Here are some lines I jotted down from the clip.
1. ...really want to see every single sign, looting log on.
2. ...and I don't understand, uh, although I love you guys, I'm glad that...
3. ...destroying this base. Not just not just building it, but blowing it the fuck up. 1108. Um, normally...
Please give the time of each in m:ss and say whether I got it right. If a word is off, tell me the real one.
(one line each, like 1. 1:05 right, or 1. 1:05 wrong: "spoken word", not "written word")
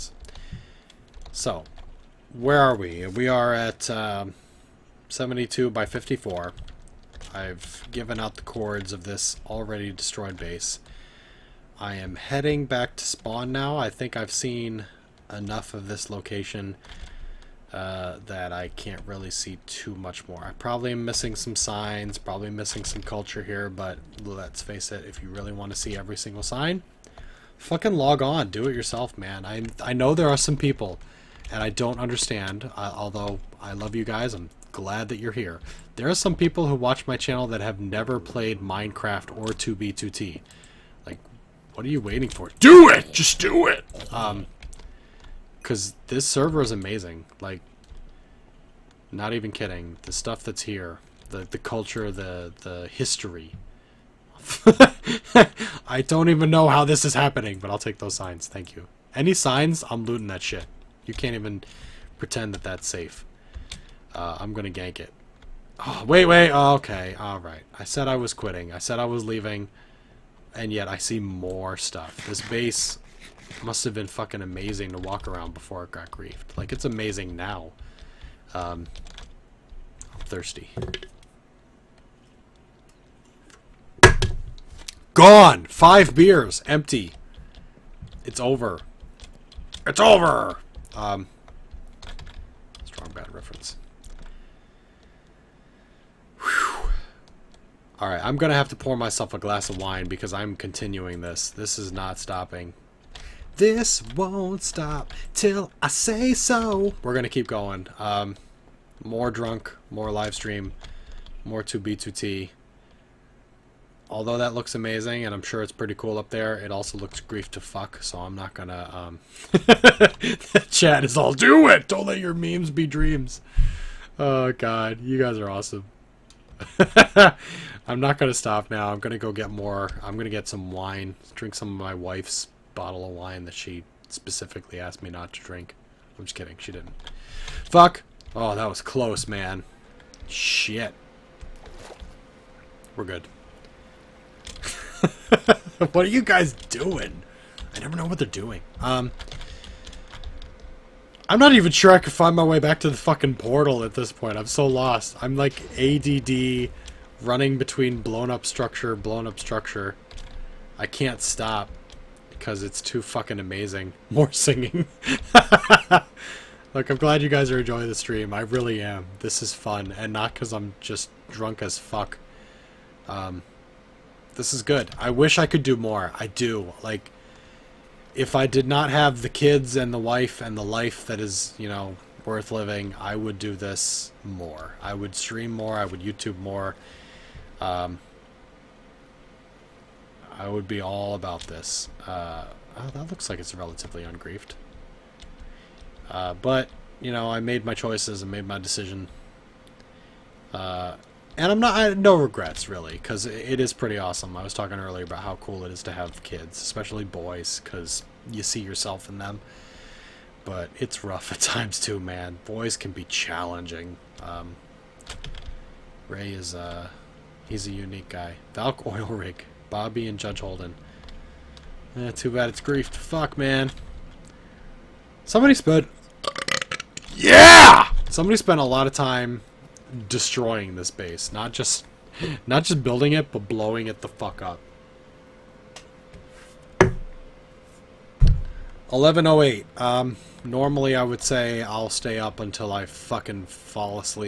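1. 0:25 wrong: "fucking", not "looting"
2. 0:31 right
3. 3:50 right.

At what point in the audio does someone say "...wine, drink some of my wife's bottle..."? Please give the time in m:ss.
2:10.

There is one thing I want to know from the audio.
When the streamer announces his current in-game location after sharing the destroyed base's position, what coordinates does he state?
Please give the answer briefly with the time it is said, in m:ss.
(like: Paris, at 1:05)
72 by 54, at 0:05.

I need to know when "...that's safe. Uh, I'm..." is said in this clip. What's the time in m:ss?
1:02.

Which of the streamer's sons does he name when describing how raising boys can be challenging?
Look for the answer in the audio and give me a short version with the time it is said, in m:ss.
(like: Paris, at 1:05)
Ray, at 3:36.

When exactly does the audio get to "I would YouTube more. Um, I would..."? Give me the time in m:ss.
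3:05.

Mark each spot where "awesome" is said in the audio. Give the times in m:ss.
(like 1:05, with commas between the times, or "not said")
2:05, 3:23.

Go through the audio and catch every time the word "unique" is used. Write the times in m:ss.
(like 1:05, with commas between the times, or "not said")
3:37.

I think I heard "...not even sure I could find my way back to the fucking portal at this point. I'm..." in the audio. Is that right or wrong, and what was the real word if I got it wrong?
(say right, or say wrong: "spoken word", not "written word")
right.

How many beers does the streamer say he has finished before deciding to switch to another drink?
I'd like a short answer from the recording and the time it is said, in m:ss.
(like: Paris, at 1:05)
5, at 1:25.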